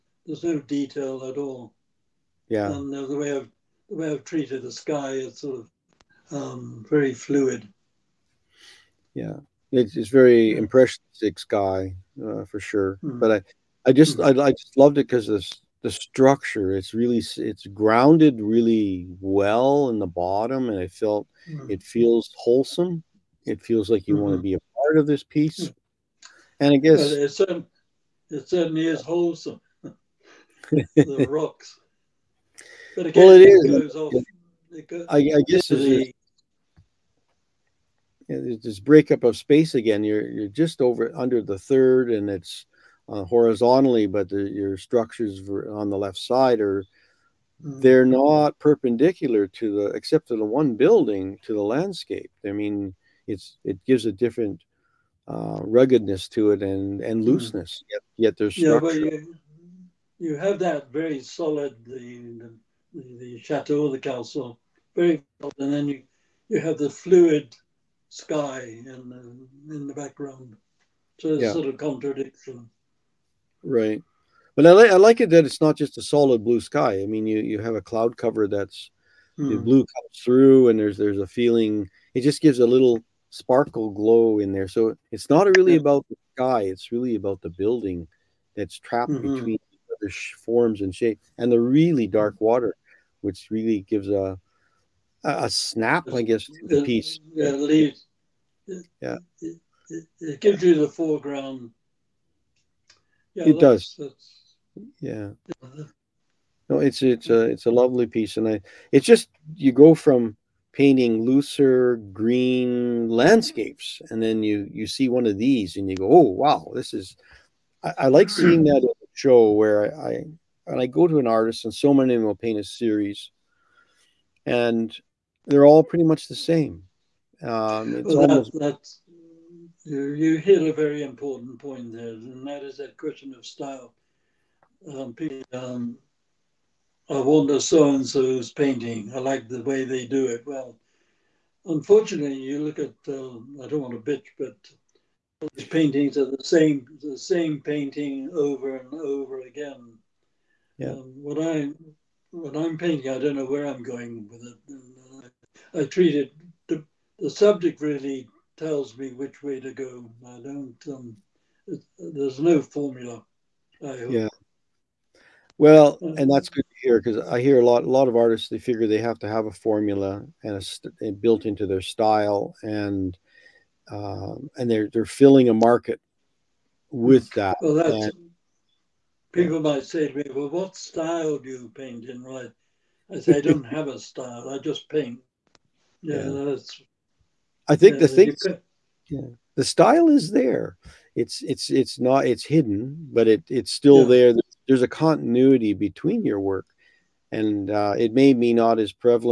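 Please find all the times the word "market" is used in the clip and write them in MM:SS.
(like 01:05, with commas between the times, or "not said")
02:55.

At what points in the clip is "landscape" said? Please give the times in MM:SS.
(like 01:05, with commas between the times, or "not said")
00:51, 01:53.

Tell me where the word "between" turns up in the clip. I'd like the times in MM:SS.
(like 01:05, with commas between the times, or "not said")
01:29, 03:15.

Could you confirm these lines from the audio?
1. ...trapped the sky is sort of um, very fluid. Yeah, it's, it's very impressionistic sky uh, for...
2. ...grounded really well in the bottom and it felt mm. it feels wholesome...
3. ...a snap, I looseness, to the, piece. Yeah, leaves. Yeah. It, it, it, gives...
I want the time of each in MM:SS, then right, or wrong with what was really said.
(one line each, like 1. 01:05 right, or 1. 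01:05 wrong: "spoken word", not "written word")
1. 00:04 wrong: "treated", not "trapped"
2. 00:17 right
3. 01:35 wrong: "guess", not "looseness".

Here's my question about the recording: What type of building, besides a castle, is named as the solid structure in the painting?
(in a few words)
chateau.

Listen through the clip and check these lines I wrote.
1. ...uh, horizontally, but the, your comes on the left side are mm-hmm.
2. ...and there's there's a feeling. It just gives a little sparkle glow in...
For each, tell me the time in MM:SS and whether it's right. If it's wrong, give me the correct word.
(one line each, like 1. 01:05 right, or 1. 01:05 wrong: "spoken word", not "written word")
1. 00:43 wrong: "structures", not "comes"
2. 01:20 right.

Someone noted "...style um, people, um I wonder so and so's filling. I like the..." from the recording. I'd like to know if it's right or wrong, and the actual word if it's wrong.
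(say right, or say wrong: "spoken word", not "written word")
wrong: "painting", not "filling".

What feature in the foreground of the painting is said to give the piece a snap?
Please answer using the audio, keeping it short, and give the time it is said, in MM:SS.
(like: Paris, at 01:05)
dark water, at 01:32.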